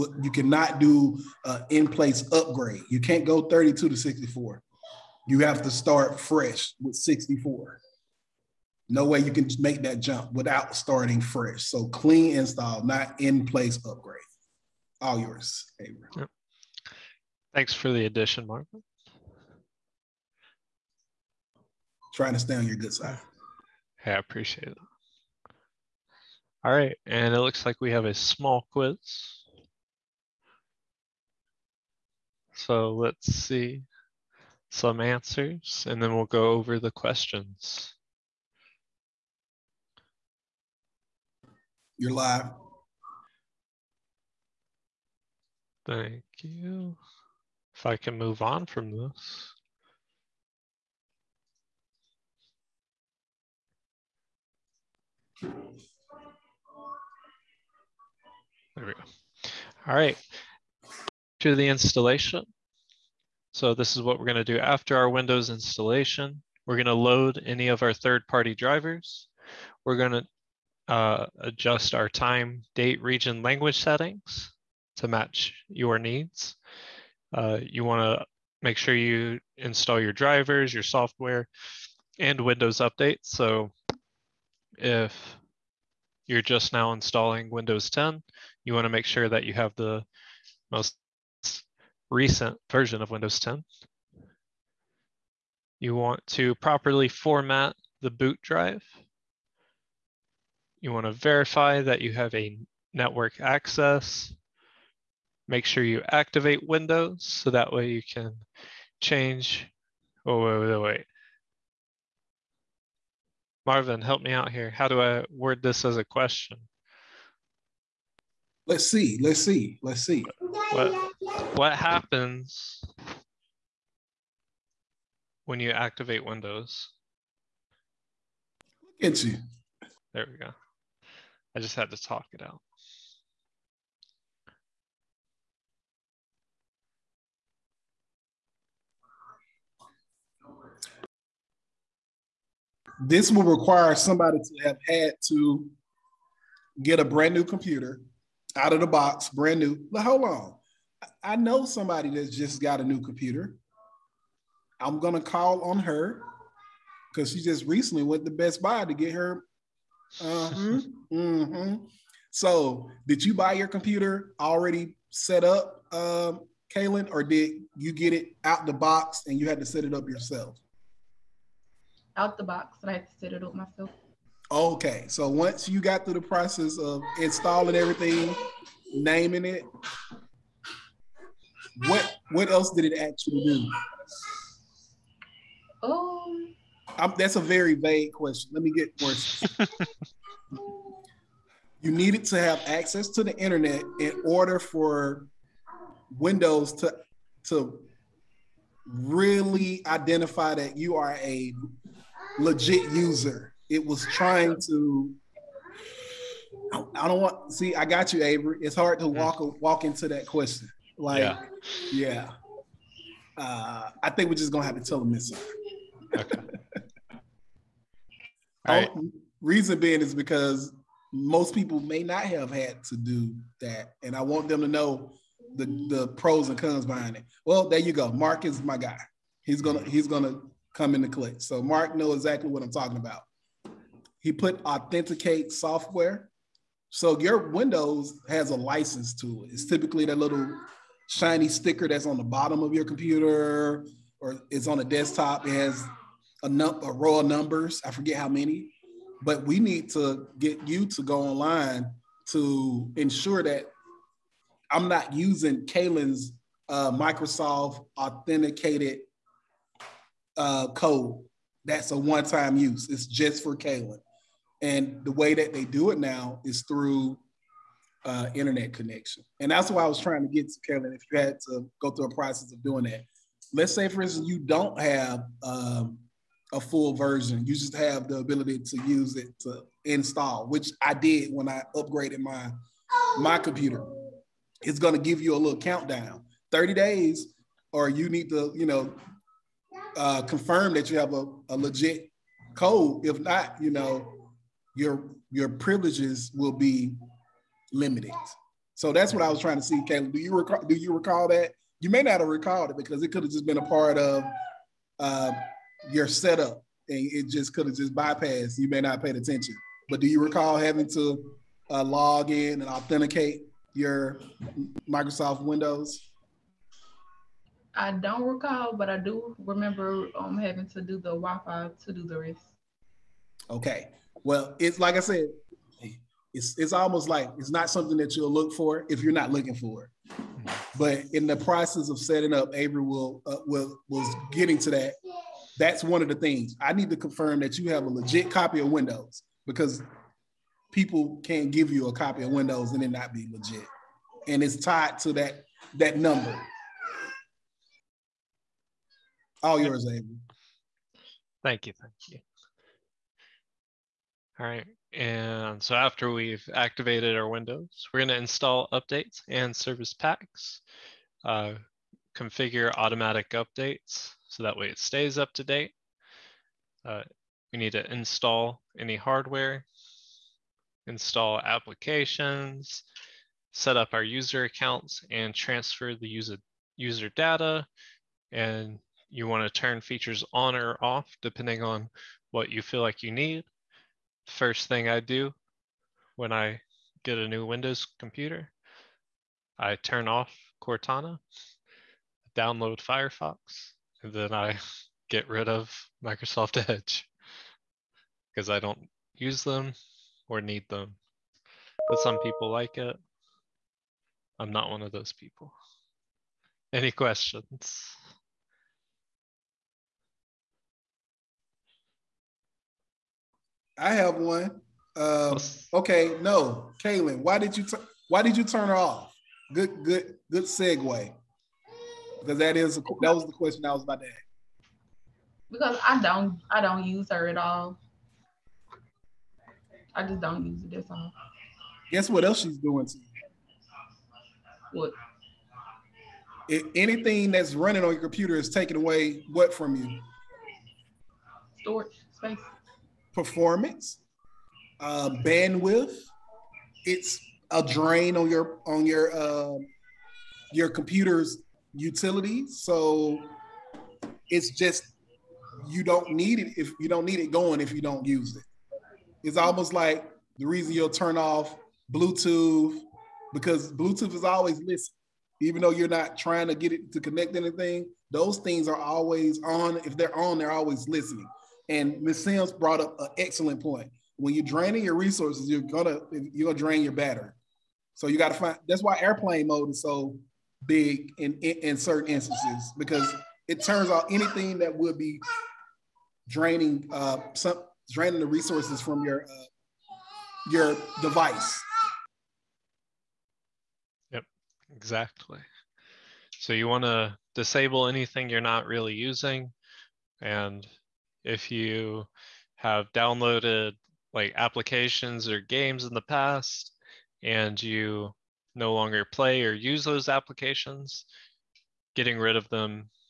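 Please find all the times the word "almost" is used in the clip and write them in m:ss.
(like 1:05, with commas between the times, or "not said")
5:26, 7:39.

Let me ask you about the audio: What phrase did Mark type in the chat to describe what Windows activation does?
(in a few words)
Authenticate software.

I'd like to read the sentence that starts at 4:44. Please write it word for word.
It's going to give you a little countdown.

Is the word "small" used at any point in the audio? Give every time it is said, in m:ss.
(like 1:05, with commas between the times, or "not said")
0:28.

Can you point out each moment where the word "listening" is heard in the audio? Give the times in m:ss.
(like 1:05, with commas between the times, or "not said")
7:44, 7:50.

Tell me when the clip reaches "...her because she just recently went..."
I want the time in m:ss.
2:35.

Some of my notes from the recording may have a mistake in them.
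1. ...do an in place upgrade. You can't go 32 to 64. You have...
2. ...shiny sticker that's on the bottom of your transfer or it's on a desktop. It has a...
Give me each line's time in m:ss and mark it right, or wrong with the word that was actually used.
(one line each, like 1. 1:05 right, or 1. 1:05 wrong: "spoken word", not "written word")
1. 0:00 right
2. 4:01 wrong: "computer", not "transfer".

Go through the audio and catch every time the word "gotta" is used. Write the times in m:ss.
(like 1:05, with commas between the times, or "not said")
7:58.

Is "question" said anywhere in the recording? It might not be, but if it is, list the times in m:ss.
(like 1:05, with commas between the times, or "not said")
0:36, 1:56, 3:08, 3:30, 6:46, 7:03.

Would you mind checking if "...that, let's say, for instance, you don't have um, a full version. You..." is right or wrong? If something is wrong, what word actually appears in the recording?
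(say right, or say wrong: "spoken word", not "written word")
right.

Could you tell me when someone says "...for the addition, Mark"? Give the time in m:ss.
0:17.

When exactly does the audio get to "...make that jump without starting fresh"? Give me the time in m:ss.
0:09.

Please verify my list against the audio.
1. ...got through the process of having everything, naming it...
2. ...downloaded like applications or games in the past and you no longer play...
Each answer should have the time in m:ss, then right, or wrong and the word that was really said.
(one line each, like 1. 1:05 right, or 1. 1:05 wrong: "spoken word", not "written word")
1. 2:55 wrong: "installing", not "having"
2. 8:22 right.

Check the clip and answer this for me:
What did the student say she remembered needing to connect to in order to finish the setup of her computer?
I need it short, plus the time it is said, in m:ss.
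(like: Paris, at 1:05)
Wi-Fi, at 5:21.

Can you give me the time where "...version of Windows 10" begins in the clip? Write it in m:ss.
1:32.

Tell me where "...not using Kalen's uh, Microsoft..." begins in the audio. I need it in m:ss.
4:14.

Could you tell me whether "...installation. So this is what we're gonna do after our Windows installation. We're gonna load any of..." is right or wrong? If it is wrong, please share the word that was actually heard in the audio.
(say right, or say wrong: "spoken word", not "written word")
right.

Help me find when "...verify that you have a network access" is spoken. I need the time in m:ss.
1:41.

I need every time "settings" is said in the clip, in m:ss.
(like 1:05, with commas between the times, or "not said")
1:13, 5:31.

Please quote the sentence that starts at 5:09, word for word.
But do you recall having to uh, log in and authenticate your Microsoft Windows?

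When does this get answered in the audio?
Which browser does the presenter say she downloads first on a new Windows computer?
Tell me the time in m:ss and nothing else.
6:32.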